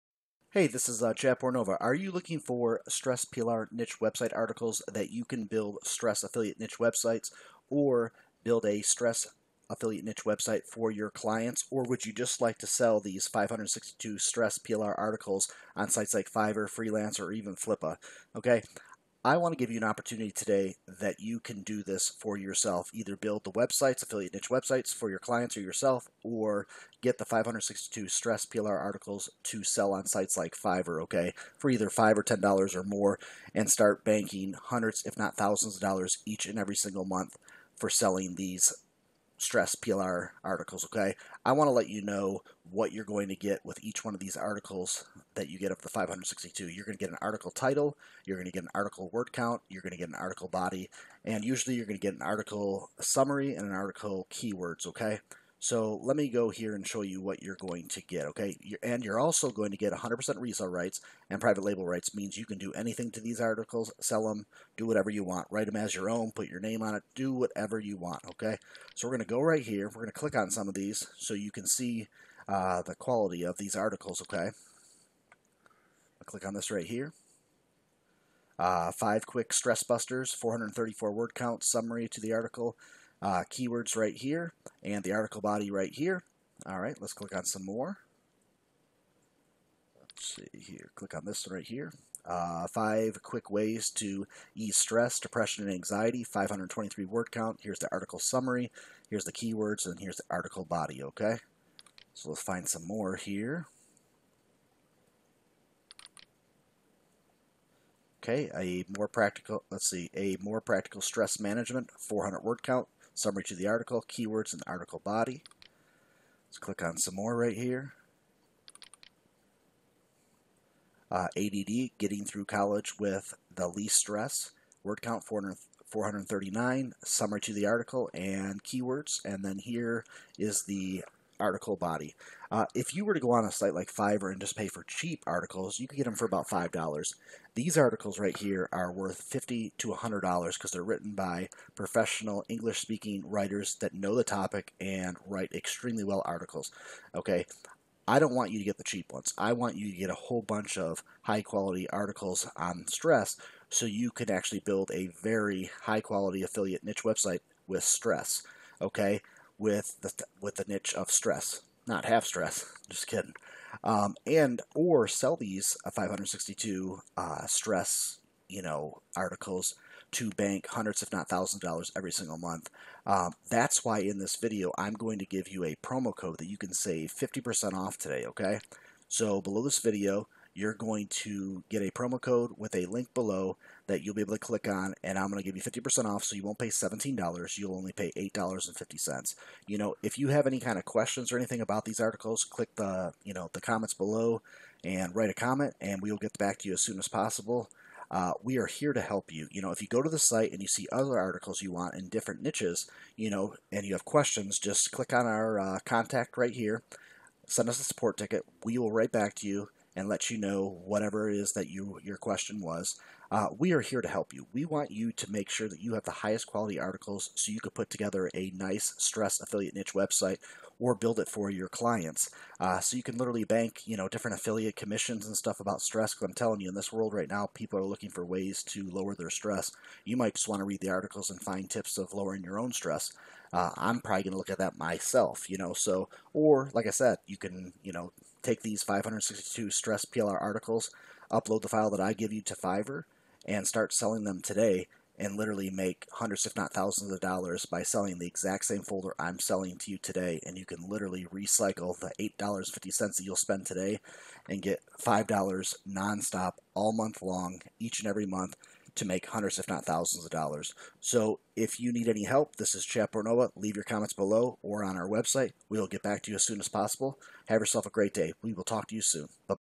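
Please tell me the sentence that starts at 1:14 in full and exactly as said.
I'll click on this right here.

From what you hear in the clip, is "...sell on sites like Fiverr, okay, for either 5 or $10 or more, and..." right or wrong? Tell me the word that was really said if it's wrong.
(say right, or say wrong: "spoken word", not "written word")
right.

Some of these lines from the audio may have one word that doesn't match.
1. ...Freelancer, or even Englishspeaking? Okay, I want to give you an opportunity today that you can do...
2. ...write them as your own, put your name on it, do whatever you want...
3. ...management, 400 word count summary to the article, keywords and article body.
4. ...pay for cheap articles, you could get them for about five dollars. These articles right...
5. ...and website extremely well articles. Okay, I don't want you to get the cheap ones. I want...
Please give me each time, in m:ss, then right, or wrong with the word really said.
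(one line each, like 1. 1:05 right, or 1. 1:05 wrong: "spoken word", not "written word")
1. 0:16 wrong: "Flippa", not "Englishspeaking"
2. 1:05 right
3. 1:51 right
4. 2:14 right
5. 2:24 wrong: "write", not "website".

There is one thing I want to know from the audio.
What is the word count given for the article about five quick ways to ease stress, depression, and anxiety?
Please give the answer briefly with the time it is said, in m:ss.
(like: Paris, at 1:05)
523, at 1:36.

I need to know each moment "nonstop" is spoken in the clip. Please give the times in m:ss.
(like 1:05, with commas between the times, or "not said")
4:15.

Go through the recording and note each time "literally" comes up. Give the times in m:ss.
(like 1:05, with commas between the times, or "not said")
3:43, 4:05, 4:10.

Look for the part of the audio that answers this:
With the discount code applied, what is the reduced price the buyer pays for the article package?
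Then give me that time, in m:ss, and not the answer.
3:07.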